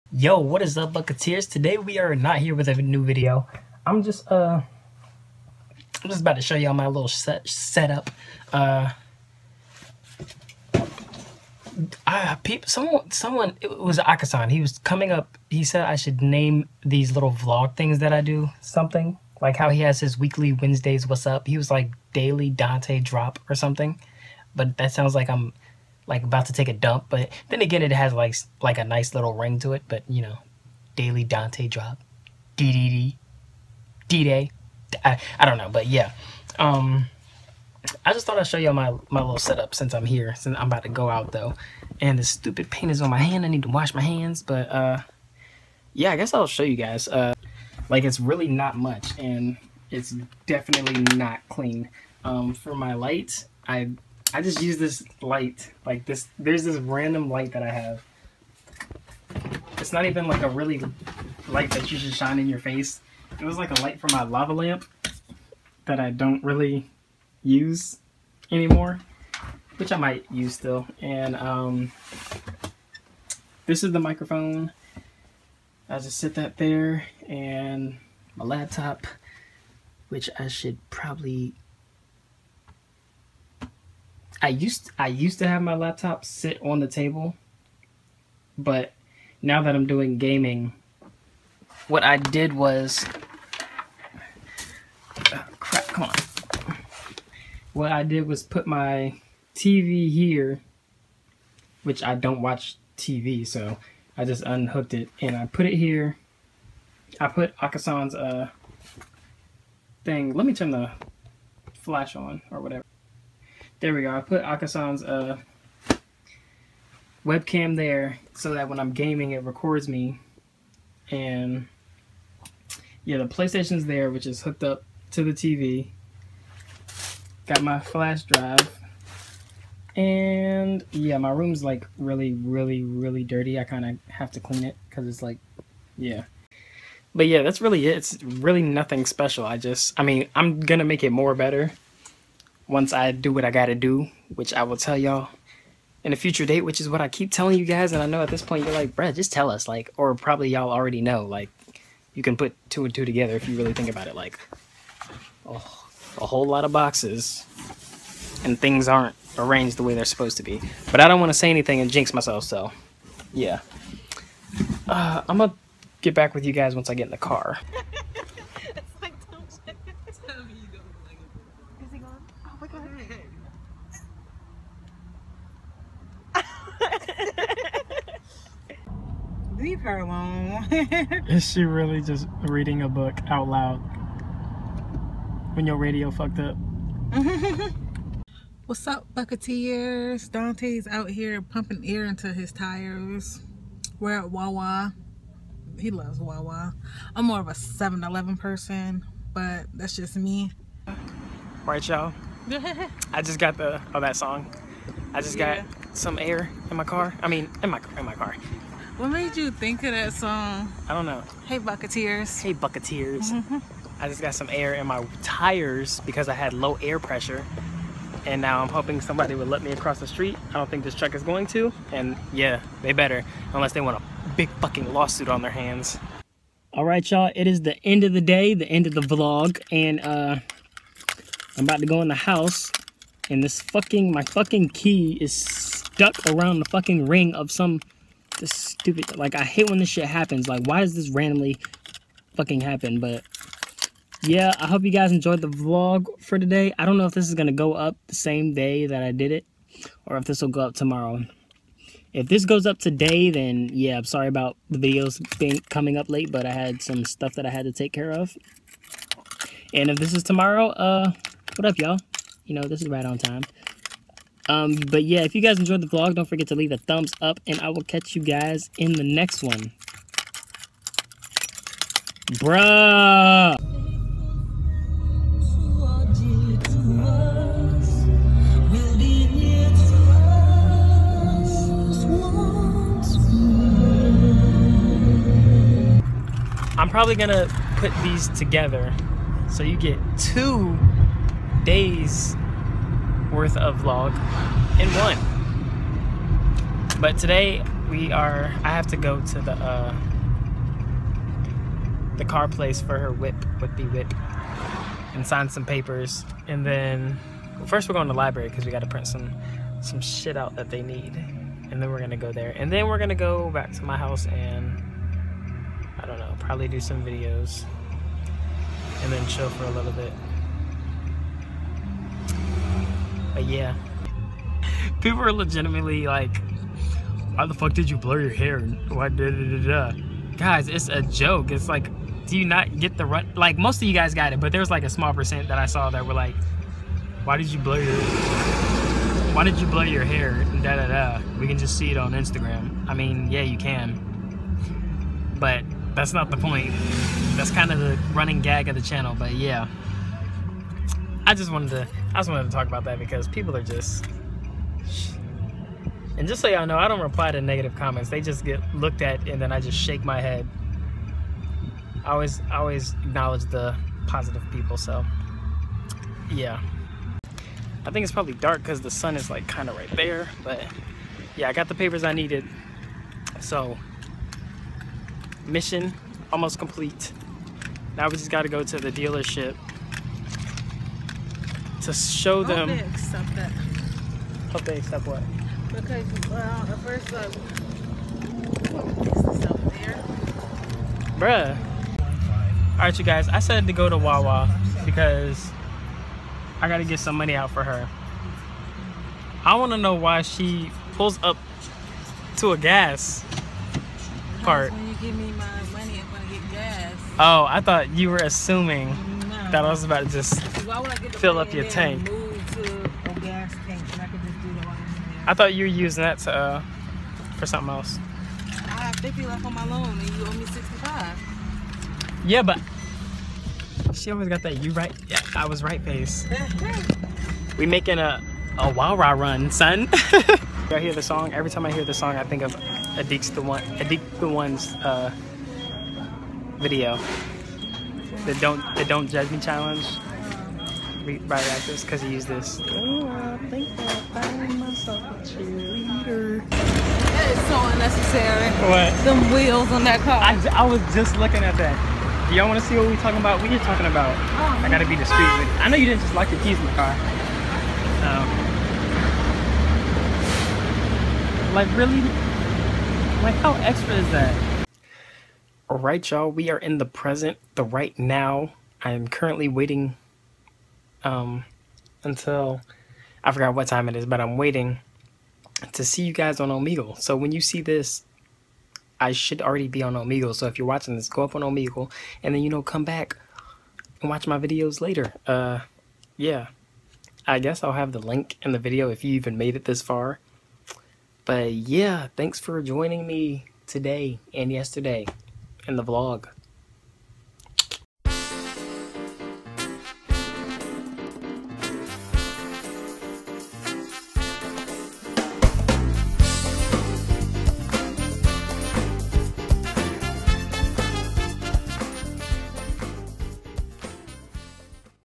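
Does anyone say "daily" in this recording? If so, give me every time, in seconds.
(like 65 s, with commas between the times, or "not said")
22 s, 30 s.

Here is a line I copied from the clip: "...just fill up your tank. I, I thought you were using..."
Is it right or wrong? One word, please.
right.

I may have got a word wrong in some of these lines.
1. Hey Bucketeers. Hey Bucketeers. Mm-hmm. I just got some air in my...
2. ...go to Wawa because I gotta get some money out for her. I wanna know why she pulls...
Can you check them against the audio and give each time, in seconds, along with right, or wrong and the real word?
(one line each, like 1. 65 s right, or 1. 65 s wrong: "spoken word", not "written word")
1. 211 s right
2. 393 s right.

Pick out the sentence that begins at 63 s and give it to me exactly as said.
It was like a light from my lava lamp that I don't really use anymore, which I might use still.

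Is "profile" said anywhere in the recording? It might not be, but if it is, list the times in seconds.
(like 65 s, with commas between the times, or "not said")
not said.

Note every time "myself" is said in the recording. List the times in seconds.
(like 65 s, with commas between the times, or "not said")
162 s, 444 s.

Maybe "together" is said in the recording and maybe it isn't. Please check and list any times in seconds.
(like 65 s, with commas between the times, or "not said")
153 s, 288 s.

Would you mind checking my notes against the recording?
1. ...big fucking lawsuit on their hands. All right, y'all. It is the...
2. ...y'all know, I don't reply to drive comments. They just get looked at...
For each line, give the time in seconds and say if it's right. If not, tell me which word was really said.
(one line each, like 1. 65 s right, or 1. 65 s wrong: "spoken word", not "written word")
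1. 224 s right
2. 356 s wrong: "negative", not "drive".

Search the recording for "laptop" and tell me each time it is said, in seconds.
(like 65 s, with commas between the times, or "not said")
78 s, 85 s.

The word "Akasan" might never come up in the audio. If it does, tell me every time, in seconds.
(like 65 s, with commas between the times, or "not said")
13 s, 107 s, 114 s.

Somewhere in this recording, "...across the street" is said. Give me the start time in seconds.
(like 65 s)
219 s.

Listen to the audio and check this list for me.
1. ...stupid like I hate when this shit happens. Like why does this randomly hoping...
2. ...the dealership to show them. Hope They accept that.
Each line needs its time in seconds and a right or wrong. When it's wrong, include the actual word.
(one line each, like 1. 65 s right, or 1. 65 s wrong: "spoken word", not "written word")
1. 238 s wrong: "fucking", not "hoping"
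2. 378 s right.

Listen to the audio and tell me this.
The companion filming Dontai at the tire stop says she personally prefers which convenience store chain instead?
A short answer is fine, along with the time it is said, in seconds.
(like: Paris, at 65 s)
7-Eleven, at 197 s.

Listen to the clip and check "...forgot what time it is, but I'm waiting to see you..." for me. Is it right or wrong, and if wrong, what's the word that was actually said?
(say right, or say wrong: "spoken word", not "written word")
right.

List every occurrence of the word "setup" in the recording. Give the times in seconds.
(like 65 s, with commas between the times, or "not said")
7 s, 39 s.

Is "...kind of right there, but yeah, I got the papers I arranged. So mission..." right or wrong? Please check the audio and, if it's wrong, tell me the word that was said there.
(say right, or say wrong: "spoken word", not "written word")
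wrong: "needed", not "arranged".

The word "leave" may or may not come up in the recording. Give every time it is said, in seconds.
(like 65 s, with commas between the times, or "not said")
179 s, 266 s.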